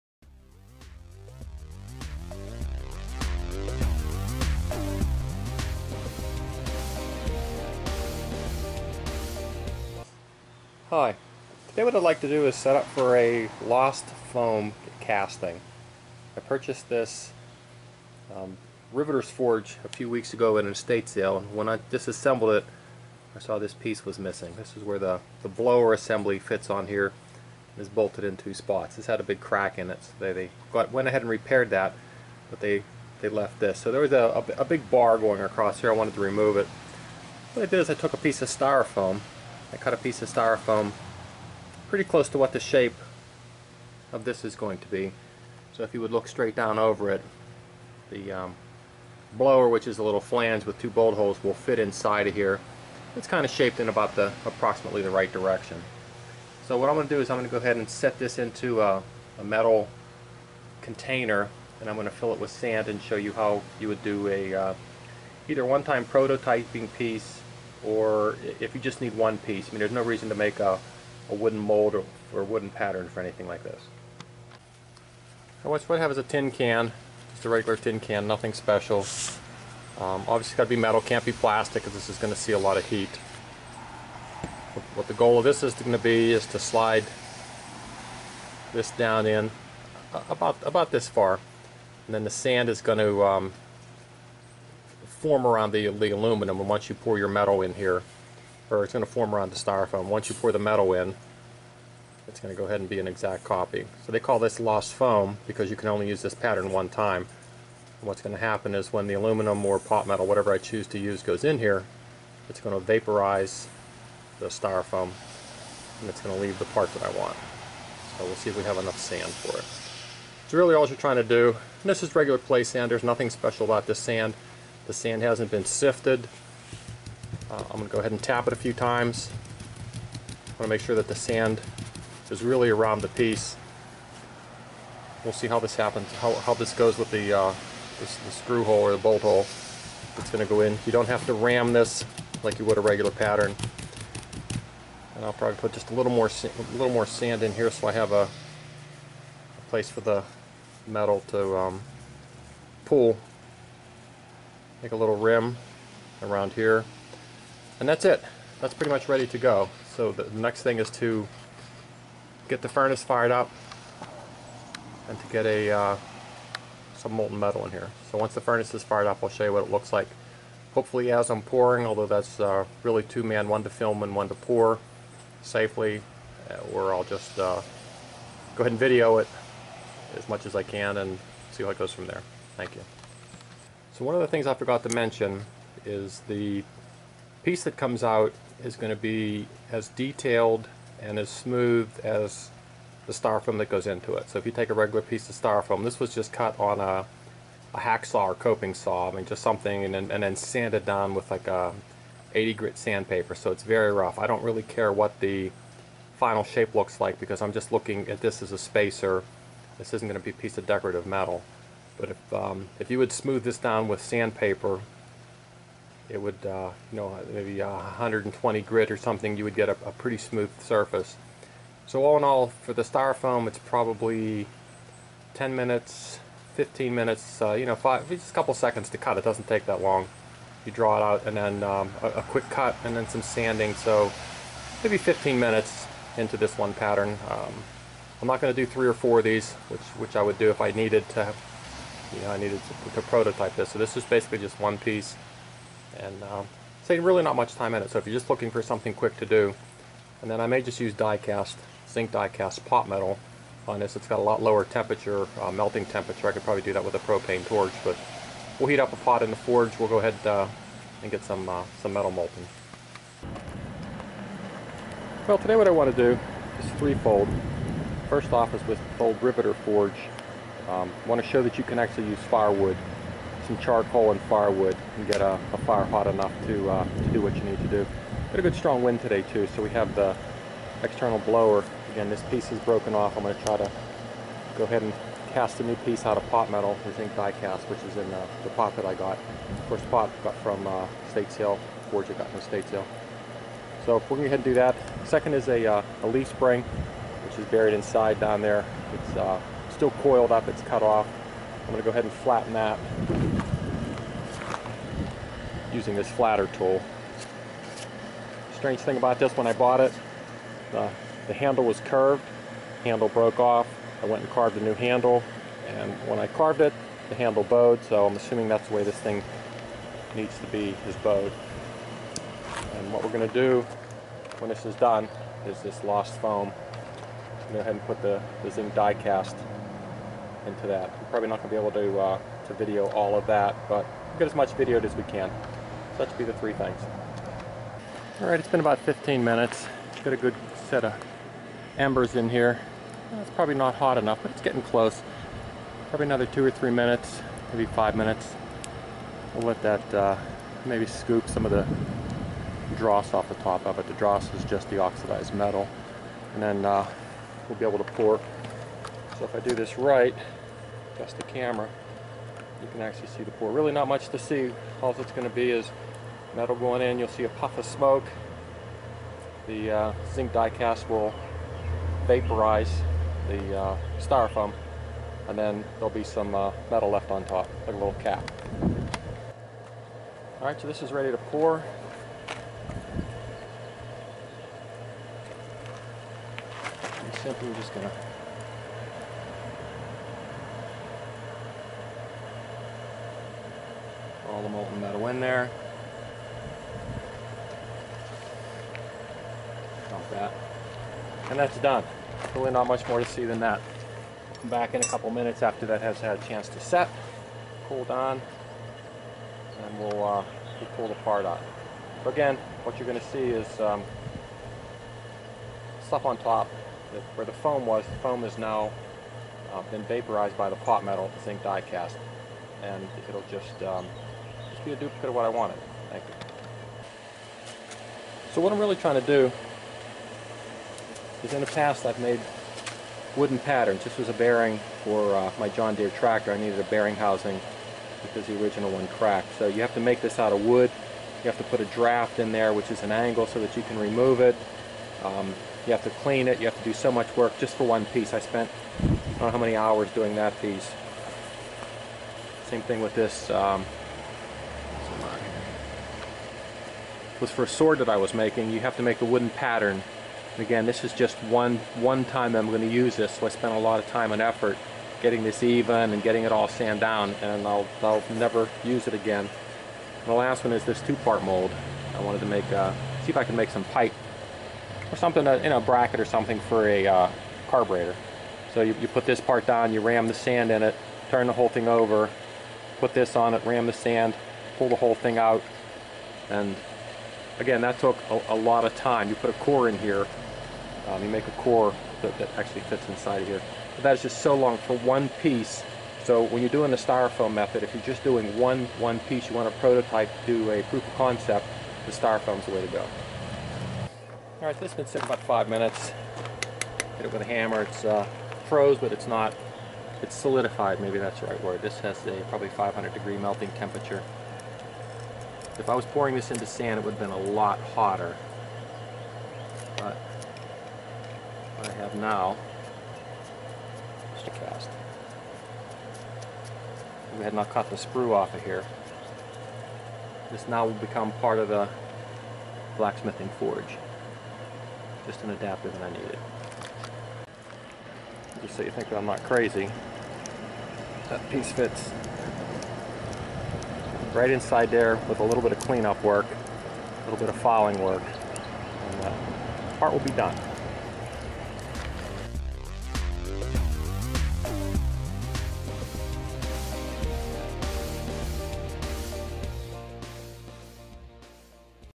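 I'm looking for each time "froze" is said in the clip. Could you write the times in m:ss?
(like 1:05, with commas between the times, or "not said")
8:28.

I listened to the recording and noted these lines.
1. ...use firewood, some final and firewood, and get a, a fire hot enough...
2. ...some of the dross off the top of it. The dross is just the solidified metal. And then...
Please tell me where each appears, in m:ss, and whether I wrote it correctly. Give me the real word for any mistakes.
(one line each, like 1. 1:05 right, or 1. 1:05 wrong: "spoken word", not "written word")
1. 4:32 wrong: "charcoal", not "final"
2. 5:51 wrong: "oxidized", not "solidified".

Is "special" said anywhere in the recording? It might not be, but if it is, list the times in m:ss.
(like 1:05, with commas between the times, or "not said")
1:18, 2:03.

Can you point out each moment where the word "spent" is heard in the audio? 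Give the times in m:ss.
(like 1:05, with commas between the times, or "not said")
7:28, 7:43.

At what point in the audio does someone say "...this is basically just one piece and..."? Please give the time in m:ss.
4:03.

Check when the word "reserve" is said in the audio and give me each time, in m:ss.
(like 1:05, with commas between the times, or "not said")
not said.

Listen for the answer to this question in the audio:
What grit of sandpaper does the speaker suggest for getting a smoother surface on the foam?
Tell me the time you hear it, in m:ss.
3:37.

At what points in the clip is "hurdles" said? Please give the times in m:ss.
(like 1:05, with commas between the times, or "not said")
not said.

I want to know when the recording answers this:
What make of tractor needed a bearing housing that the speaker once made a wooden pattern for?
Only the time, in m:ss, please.
7:15.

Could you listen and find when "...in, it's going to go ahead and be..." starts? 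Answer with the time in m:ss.
1:40.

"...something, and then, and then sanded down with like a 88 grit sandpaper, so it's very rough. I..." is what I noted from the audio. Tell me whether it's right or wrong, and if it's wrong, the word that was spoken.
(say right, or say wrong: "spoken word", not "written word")
wrong: "80", not "88".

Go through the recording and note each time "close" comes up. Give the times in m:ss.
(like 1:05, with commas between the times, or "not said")
0:42, 5:44.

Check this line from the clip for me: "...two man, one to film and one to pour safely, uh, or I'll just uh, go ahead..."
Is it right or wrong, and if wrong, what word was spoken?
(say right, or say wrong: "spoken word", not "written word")
right.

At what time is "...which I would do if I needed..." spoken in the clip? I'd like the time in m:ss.
3:59.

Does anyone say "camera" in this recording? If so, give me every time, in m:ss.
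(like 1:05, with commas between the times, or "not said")
6:01.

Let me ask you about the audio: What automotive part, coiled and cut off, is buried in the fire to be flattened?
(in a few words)
leaf spring.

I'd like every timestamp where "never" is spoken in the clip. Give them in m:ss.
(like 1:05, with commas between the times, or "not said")
7:48.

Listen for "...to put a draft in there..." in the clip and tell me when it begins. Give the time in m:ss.
7:21.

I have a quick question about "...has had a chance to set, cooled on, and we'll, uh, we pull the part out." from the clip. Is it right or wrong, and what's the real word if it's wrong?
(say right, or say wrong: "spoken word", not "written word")
right.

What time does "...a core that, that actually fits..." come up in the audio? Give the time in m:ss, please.
8:11.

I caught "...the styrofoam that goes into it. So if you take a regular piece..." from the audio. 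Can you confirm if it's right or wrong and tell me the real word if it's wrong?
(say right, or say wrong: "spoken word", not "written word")
right.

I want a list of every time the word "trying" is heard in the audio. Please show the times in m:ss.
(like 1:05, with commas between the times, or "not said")
2:00, 7:08.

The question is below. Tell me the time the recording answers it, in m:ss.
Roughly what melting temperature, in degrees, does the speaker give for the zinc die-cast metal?
8:32.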